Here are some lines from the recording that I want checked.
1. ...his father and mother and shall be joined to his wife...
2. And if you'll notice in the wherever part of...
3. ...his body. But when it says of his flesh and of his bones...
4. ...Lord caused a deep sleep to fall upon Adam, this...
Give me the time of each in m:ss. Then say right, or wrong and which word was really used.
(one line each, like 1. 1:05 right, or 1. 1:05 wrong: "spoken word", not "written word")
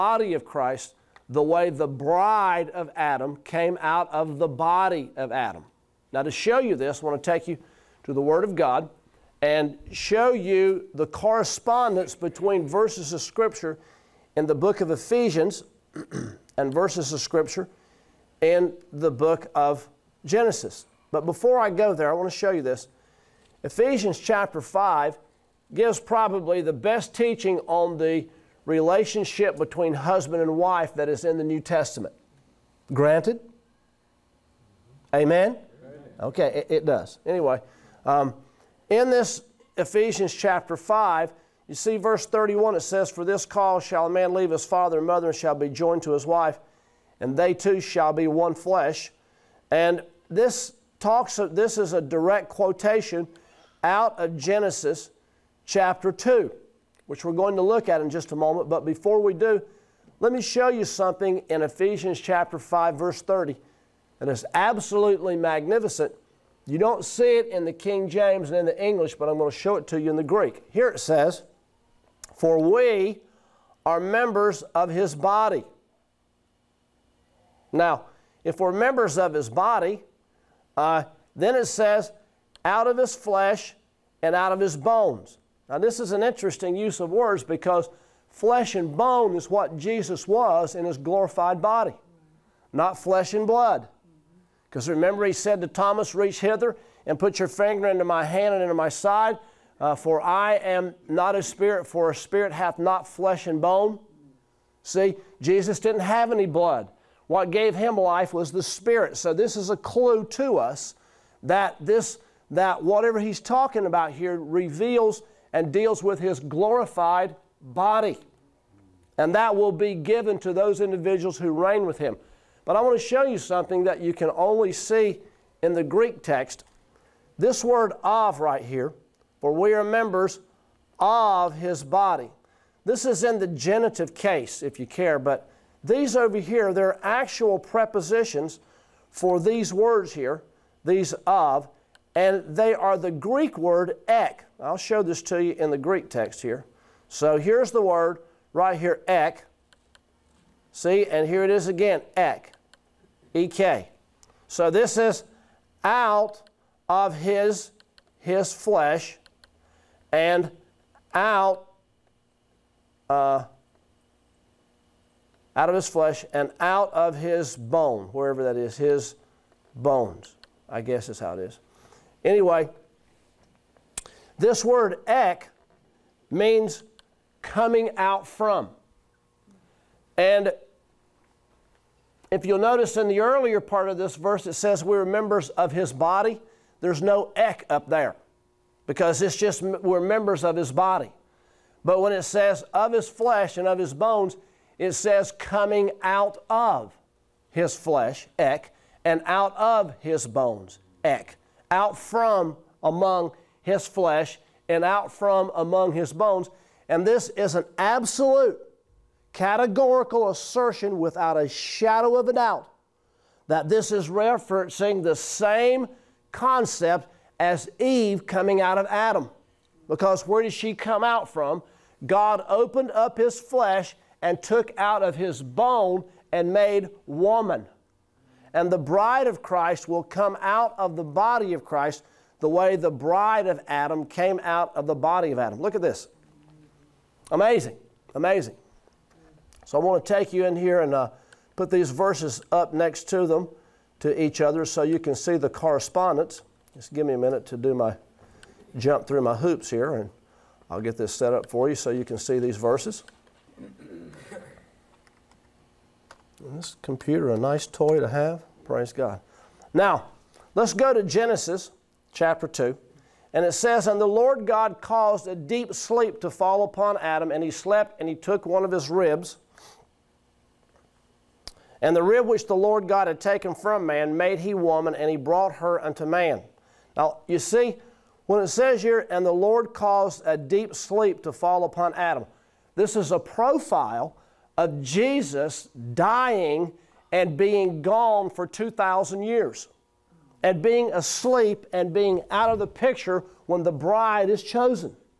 1. 0:44 right
2. 3:00 wrong: "earlier", not "wherever"
3. 3:10 right
4. 4:39 right.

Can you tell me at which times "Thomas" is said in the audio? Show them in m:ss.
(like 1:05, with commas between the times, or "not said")
1:35.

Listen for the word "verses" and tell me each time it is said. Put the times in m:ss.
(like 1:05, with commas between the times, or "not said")
0:12, 0:16, 0:41, 1:02, 3:04, 4:01, 4:12.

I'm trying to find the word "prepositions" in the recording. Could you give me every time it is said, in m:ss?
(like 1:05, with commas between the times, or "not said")
2:17.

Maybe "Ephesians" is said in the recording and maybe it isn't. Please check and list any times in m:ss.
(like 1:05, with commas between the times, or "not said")
0:14, 0:23, 0:39, 1:01.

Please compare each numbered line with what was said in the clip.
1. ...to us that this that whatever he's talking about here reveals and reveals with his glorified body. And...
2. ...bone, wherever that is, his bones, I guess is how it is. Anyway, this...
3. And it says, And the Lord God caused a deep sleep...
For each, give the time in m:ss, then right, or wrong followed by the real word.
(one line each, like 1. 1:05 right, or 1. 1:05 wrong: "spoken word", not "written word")
1. 1:50 wrong: "deals", not "reveals"
2. 2:47 right
3. 4:23 right.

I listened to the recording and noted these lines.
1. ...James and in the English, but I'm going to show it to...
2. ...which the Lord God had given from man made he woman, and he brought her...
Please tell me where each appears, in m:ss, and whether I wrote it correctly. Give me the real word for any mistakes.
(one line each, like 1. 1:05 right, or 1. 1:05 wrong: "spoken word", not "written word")
1. 1:08 right
2. 4:32 wrong: "taken", not "given".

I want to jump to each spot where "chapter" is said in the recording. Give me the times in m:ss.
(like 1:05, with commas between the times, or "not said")
0:24, 0:40, 0:55, 1:02, 4:22.